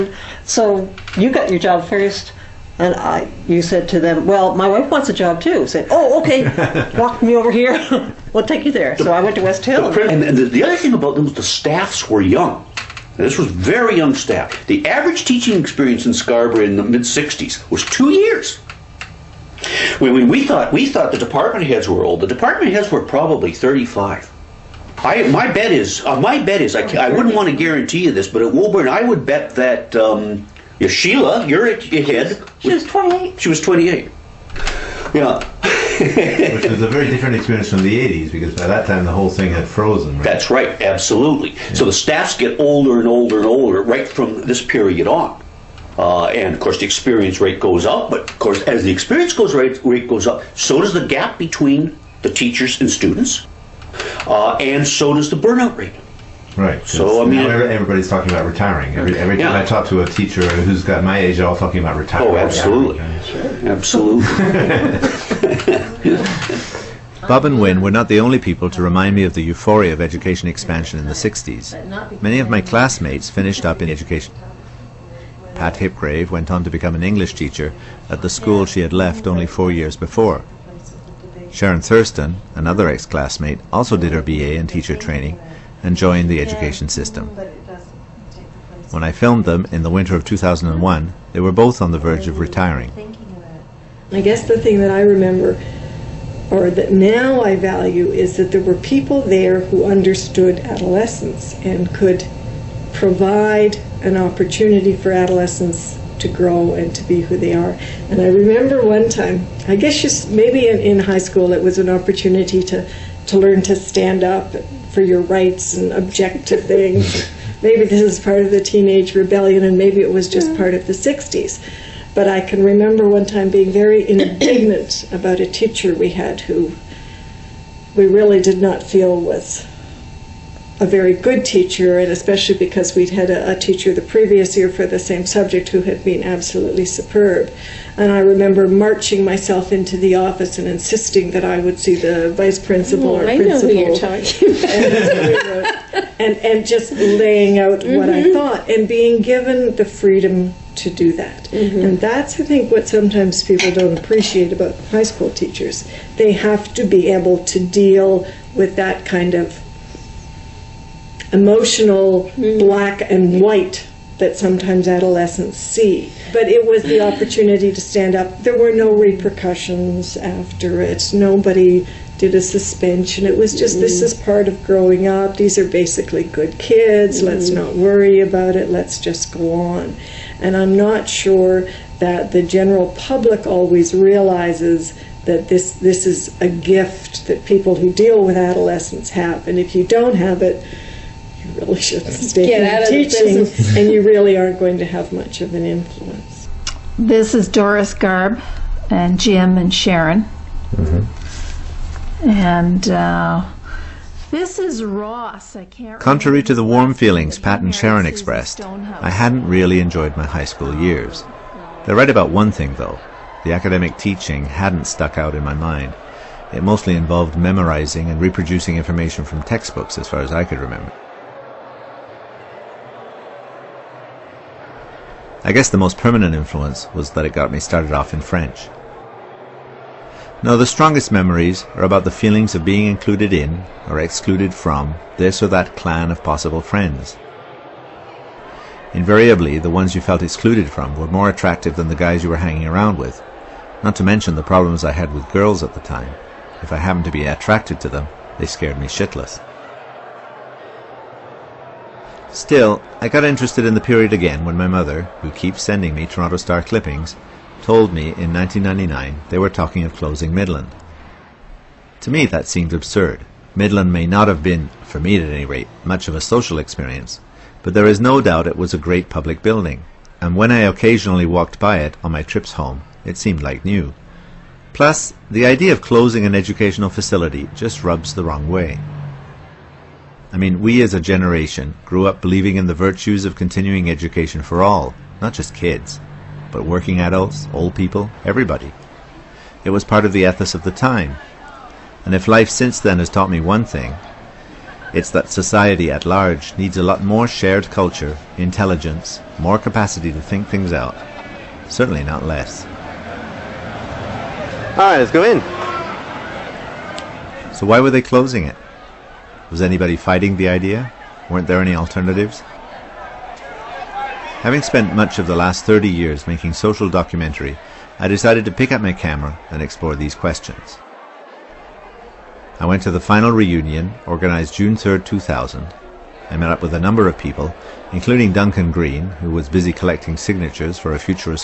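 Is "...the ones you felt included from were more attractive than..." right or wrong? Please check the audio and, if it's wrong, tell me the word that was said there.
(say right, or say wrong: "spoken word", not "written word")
wrong: "excluded", not "included".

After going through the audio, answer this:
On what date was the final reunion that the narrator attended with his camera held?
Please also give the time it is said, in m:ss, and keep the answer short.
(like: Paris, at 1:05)
June 3, 2000, at 5:24.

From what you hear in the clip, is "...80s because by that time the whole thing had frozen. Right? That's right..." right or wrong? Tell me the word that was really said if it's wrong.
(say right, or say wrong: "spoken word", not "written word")
right.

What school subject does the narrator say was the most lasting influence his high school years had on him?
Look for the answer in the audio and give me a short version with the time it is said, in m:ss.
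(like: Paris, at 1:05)
French, at 3:48.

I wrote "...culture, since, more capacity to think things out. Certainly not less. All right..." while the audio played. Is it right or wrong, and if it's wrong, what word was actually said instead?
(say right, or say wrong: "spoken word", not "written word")
wrong: "intelligence", not "since".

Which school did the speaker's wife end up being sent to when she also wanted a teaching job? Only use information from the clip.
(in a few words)
West Hill.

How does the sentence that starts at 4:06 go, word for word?
If I happened to be attracted to them, they scared me shitless.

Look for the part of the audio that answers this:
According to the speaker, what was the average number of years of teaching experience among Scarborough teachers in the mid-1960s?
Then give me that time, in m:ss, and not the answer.
0:17.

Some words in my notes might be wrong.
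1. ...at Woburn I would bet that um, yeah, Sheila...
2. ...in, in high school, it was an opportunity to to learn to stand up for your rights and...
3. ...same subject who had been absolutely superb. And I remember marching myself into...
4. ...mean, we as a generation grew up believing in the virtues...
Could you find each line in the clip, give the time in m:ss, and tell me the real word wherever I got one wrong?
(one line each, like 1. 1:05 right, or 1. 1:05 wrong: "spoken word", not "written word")
1. 0:28 right
2. 1:50 right
3. 2:14 right
4. 4:40 right.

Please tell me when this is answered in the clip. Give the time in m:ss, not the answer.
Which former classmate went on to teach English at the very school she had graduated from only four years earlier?
1:15.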